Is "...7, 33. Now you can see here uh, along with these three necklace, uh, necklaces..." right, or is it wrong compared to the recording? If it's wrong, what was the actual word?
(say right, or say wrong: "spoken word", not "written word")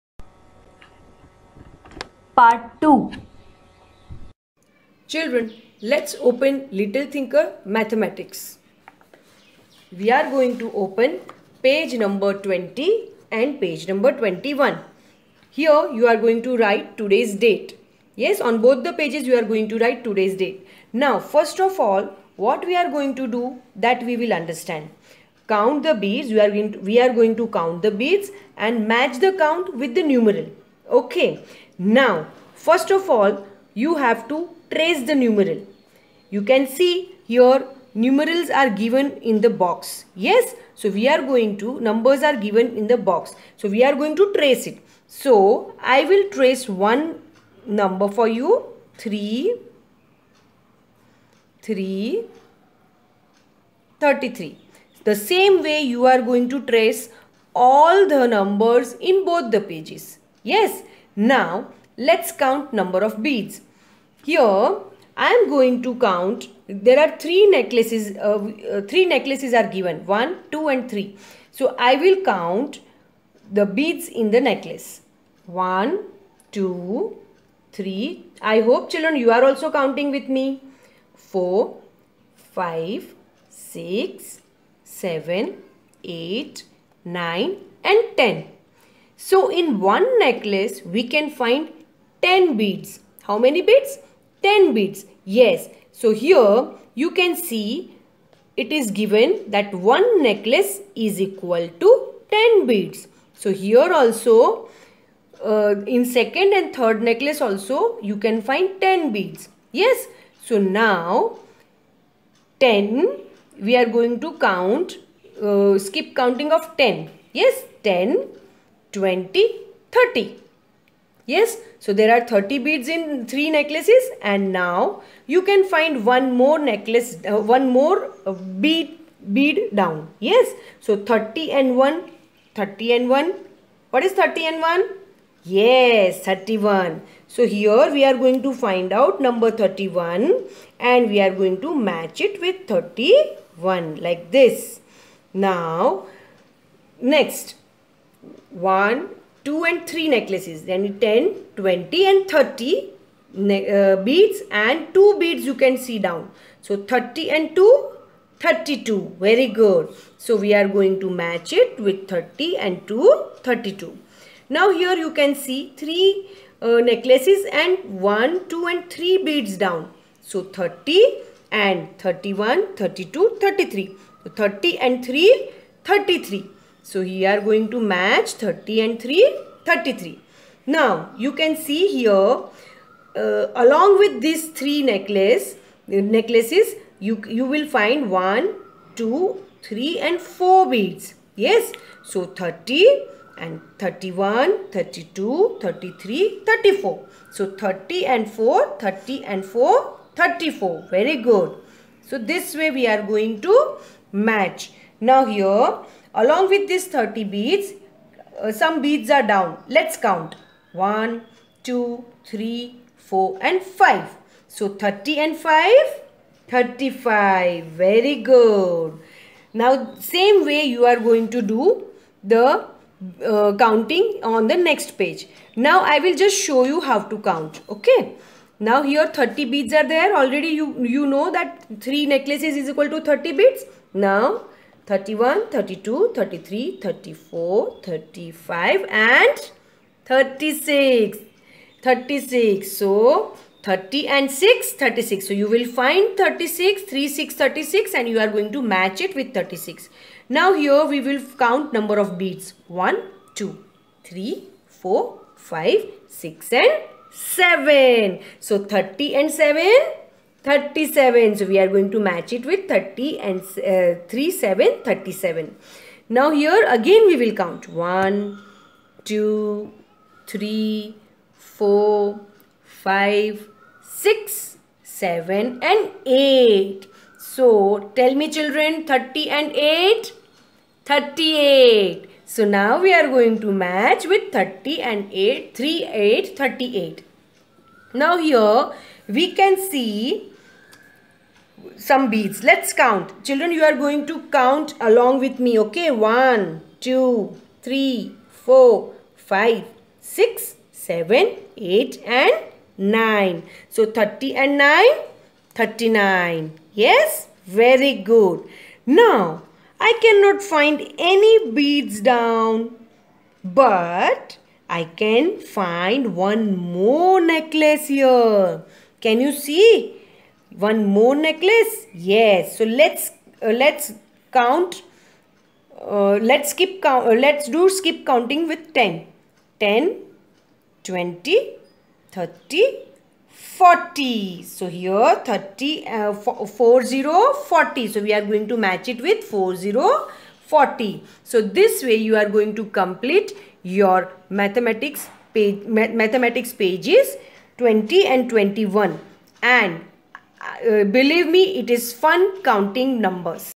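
wrong: "3", not "7".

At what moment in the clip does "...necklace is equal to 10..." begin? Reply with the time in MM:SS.
01:40.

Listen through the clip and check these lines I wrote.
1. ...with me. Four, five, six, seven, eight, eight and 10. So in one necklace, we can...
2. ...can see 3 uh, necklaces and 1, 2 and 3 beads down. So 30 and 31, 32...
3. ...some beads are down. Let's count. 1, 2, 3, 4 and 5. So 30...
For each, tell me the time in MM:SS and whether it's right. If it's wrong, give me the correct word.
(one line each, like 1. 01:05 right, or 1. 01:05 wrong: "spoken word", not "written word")
1. 01:20 wrong: "nine", not "eight"
2. 02:45 right
3. 03:28 right.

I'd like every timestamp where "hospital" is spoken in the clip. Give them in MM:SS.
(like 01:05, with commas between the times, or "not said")
not said.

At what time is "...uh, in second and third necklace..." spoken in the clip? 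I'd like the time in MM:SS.
01:45.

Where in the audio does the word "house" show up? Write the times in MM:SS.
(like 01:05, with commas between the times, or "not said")
not said.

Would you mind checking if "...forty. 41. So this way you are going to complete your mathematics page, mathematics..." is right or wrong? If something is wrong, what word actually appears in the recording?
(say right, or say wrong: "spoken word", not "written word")
wrong: "40", not "41".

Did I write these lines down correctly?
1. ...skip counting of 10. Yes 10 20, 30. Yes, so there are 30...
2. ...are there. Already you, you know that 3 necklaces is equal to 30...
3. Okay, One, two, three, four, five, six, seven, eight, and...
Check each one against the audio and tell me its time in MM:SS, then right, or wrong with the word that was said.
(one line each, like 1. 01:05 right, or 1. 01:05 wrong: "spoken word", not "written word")
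1. 01:55 right
2. 03:49 right
3. 04:55 right.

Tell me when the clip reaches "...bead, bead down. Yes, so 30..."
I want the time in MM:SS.
02:08.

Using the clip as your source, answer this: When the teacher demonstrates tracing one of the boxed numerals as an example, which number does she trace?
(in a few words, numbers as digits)
33.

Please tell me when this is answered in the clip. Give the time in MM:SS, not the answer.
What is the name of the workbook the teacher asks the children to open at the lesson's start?
00:06.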